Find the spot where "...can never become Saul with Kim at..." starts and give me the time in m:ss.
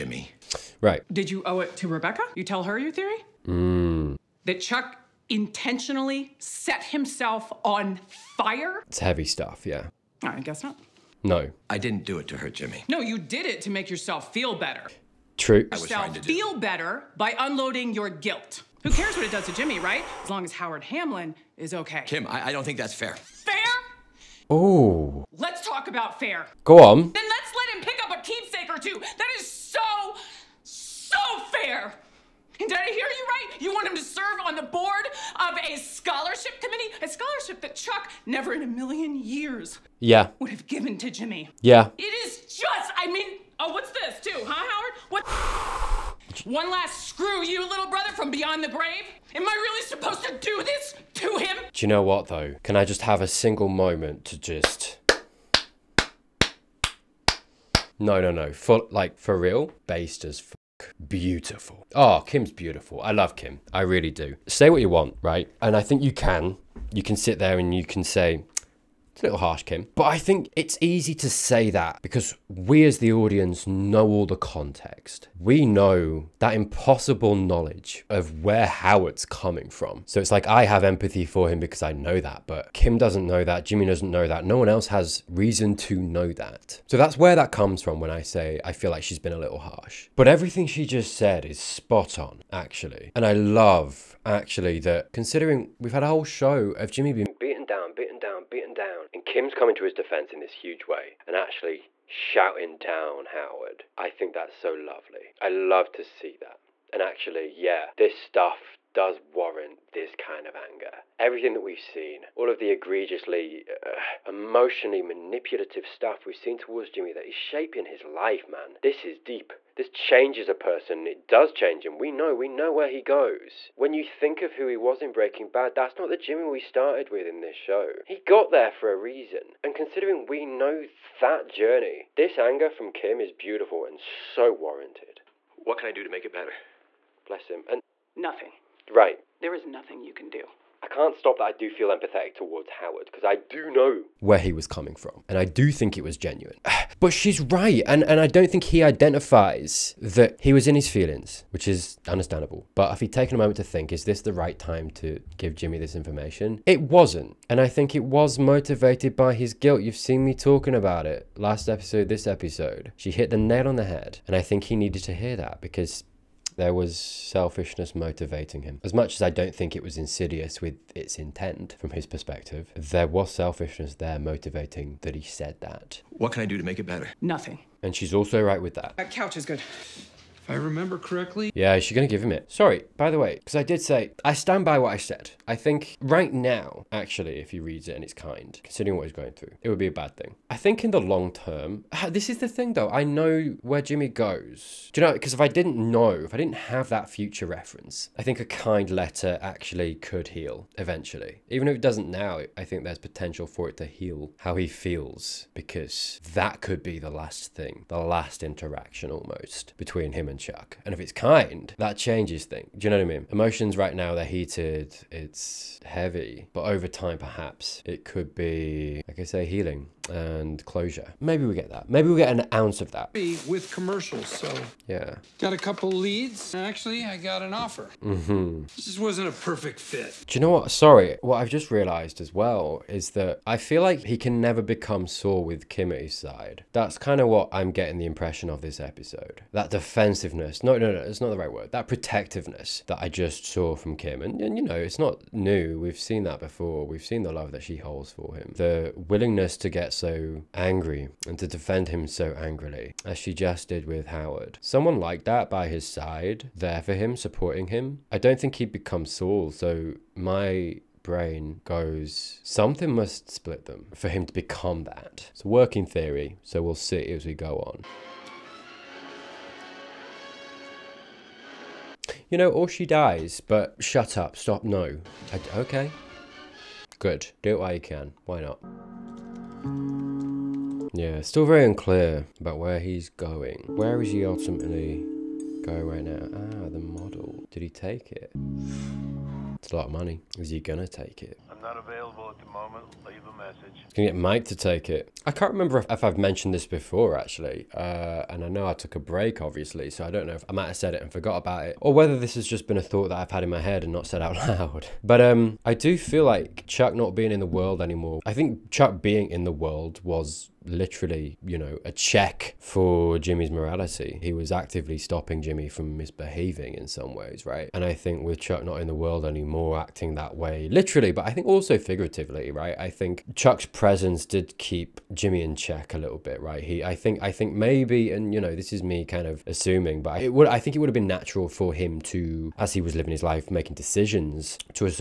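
3:54.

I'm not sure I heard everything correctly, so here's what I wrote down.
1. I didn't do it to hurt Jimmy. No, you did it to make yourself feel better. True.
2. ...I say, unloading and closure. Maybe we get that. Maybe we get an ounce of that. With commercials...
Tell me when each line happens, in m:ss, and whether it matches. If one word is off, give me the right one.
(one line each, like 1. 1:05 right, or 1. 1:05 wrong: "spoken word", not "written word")
1. 0:11 right
2. 3:39 wrong: "healing", not "unloading".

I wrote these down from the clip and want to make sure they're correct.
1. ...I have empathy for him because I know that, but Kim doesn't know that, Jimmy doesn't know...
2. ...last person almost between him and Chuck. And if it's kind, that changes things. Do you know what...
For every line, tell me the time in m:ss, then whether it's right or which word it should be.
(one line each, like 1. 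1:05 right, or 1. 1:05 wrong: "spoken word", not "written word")
1. 1:20 right
2. 3:27 wrong: "interaction", not "person".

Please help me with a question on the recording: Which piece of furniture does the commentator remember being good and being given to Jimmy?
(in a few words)
Couch.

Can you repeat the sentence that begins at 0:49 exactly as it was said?
Am I really supposed to do this to him?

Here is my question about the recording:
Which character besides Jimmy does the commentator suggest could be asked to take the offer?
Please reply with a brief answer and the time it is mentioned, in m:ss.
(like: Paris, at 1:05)
Mike, at 4:54.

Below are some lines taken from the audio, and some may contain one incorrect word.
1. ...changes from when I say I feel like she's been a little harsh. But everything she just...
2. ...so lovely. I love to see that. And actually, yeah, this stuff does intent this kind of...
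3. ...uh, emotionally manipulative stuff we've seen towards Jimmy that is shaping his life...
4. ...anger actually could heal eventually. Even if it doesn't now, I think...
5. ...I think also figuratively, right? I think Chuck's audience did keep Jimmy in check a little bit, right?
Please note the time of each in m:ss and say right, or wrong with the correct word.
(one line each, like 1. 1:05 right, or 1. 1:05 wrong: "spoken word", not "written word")
1. 1:27 wrong: "comes", not "changes"
2. 1:44 wrong: "warrant", not "intent"
3. 1:53 right
4. 3:18 wrong: "letter", not "anger"
5. 5:21 wrong: "presence", not "audience".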